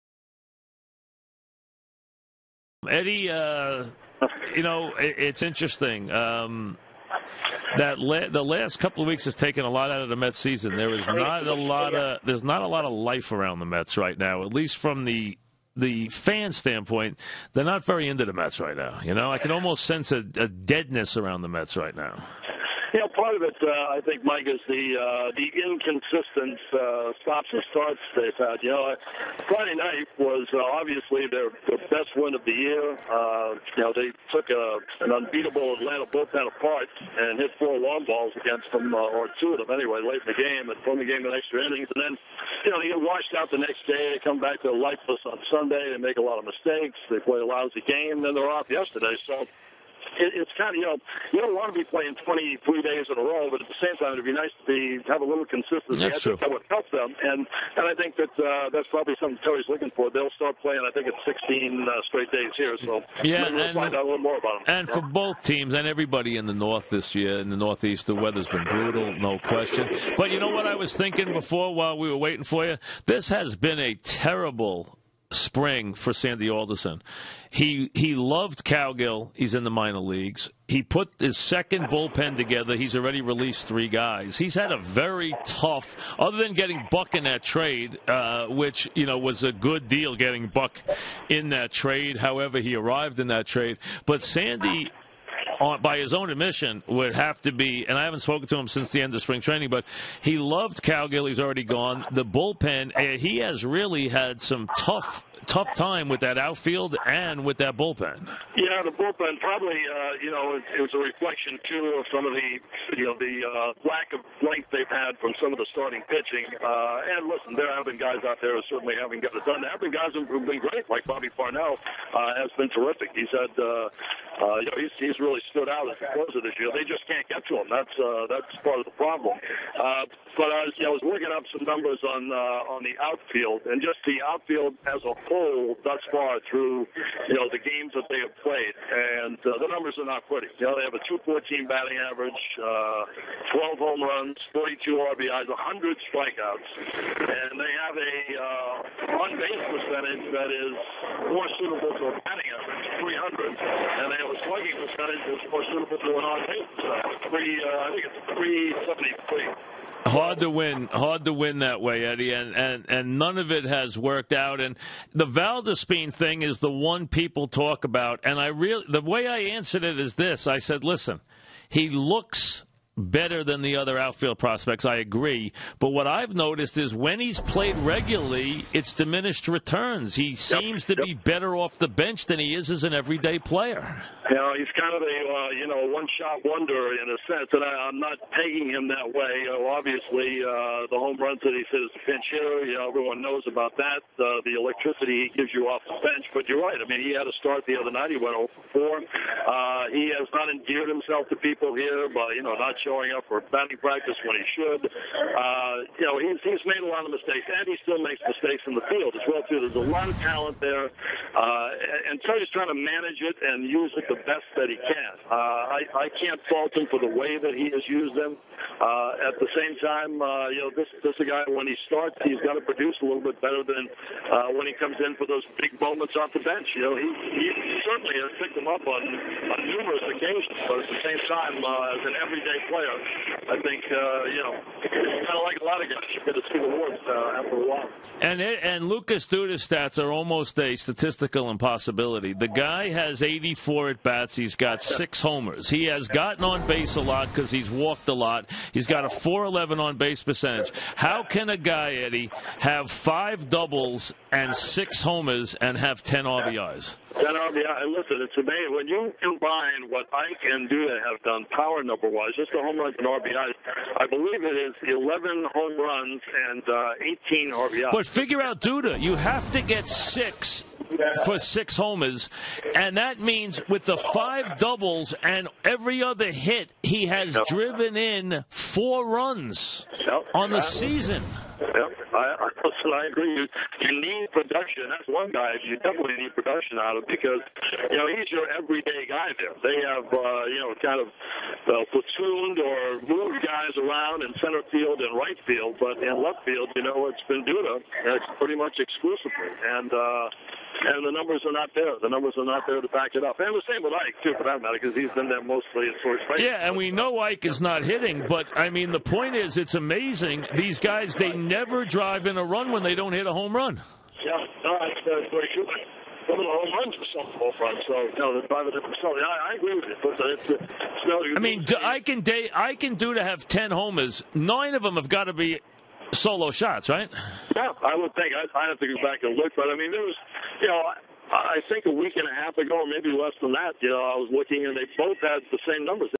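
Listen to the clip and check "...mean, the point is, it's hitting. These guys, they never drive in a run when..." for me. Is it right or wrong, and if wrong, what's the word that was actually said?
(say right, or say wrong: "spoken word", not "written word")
wrong: "amazing", not "hitting".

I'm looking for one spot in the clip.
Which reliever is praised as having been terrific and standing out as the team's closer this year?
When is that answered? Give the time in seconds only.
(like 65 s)
121 s.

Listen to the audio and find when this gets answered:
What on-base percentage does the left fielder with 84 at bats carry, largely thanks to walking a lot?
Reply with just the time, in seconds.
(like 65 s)
249 s.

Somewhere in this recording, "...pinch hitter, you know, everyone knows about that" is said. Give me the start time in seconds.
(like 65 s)
192 s.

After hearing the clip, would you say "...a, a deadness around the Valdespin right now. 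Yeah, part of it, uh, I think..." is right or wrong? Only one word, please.
wrong.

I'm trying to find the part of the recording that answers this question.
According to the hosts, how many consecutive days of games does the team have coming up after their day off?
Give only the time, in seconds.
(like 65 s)
61 s.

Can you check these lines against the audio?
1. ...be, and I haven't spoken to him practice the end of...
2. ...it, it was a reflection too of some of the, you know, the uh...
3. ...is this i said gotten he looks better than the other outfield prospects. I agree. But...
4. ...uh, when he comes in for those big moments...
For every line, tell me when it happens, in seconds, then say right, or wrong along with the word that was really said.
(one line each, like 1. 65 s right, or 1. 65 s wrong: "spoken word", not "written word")
1. 97 s wrong: "since", not "practice"
2. 110 s right
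3. 169 s wrong: "listen", not "gotten"
4. 224 s right.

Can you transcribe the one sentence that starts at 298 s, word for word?
That's pretty much exclusively, and uh, and the numbers are not there.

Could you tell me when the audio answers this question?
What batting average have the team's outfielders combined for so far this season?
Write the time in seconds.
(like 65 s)
141 s.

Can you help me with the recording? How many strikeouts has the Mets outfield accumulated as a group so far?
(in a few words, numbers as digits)
100.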